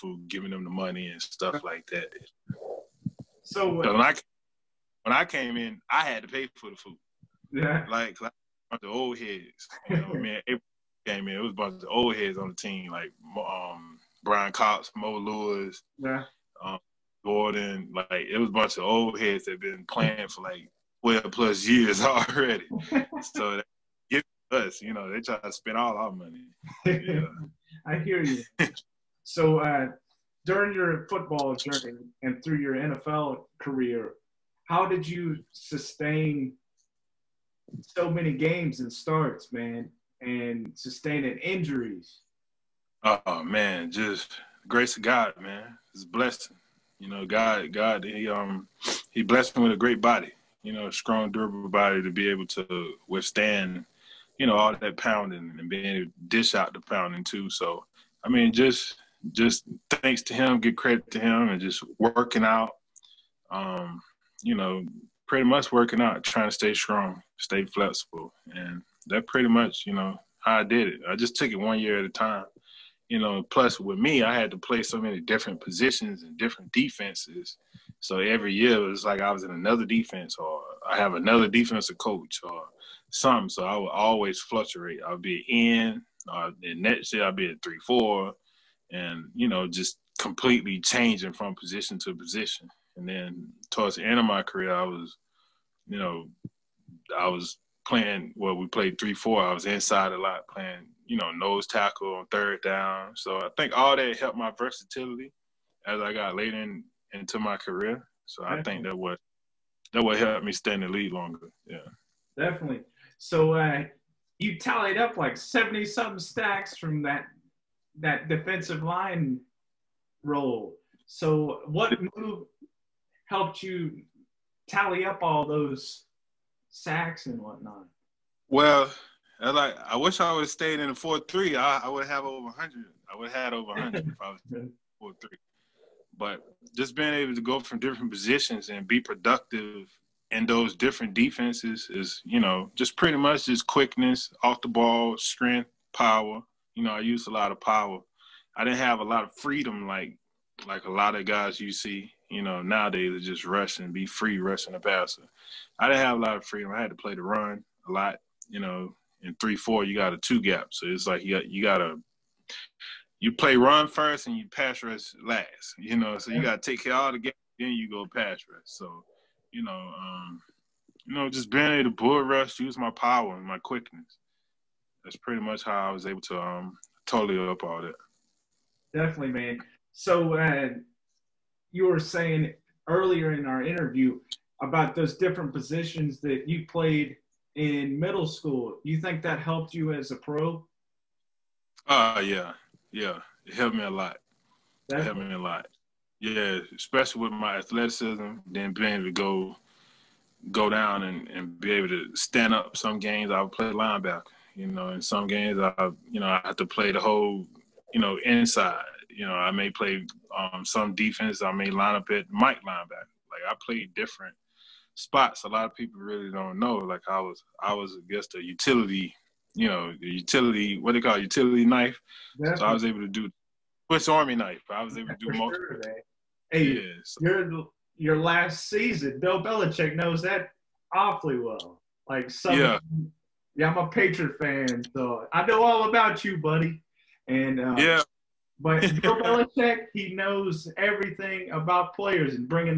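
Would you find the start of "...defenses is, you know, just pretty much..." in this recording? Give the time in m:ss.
2:21.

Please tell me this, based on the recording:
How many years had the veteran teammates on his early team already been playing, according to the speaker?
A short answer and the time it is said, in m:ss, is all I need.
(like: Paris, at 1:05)
12 plus years, at 0:21.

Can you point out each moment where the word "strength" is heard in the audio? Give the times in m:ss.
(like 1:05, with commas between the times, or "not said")
2:25.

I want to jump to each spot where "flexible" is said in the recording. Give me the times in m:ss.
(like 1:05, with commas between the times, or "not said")
1:07.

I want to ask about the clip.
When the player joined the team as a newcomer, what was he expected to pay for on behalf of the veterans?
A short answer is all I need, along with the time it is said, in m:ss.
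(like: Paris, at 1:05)
The food, at 0:06.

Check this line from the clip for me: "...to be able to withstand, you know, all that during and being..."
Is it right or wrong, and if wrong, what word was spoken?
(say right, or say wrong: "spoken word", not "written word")
wrong: "pounding", not "during".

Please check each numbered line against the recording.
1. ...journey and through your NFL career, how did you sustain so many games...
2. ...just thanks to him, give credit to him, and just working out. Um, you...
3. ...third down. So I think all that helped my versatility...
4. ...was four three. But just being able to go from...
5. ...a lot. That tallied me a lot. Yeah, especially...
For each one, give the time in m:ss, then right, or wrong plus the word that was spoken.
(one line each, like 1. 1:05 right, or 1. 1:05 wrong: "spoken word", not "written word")
1. 0:31 right
2. 0:59 right
3. 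1:42 right
4. 2:14 right
5. 3:13 wrong: "helped", not "tallied".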